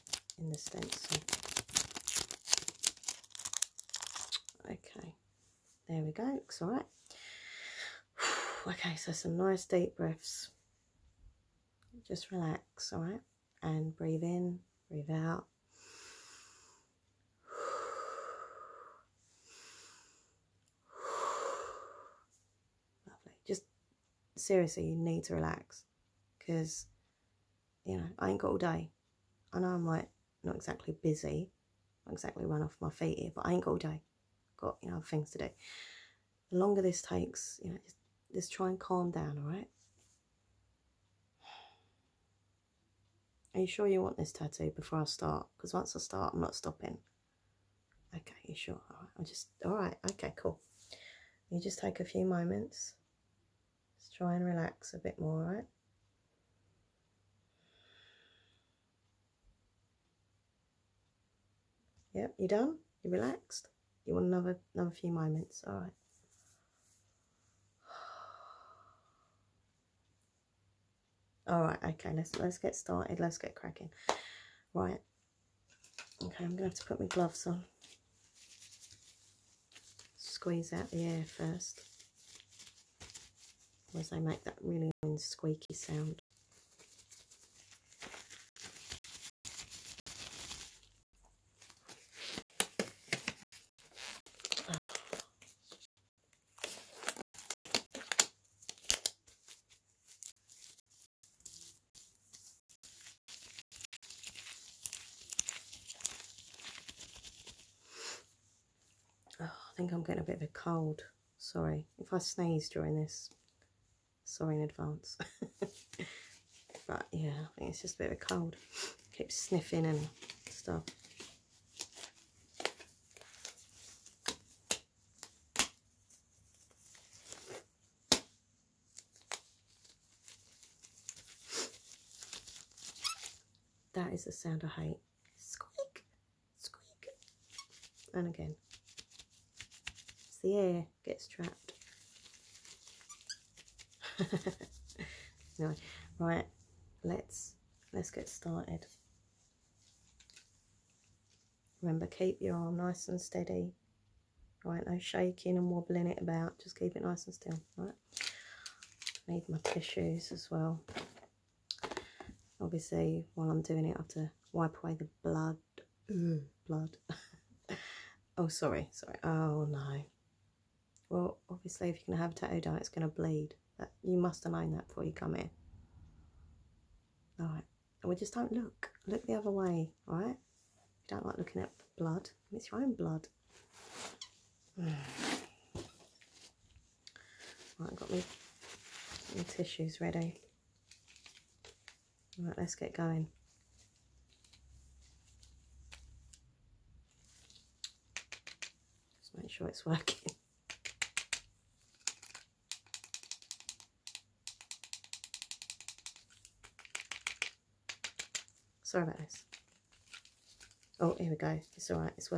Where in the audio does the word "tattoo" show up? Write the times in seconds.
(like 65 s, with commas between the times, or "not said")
44 s, 172 s.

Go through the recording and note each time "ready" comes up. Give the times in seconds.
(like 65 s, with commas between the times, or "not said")
190 s.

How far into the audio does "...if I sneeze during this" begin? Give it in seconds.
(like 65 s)
111 s.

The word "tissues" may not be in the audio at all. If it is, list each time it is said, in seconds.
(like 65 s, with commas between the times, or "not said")
159 s, 189 s.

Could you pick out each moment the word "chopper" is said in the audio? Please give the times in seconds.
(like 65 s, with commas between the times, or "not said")
not said.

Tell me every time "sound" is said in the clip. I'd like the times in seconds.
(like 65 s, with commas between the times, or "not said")
85 s, 134 s.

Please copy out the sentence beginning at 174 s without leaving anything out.
You must align that before you come in.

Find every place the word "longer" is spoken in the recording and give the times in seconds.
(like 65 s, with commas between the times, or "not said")
36 s.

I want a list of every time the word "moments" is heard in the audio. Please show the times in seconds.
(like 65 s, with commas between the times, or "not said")
52 s, 65 s.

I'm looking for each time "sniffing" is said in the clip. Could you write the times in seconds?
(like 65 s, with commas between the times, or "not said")
119 s.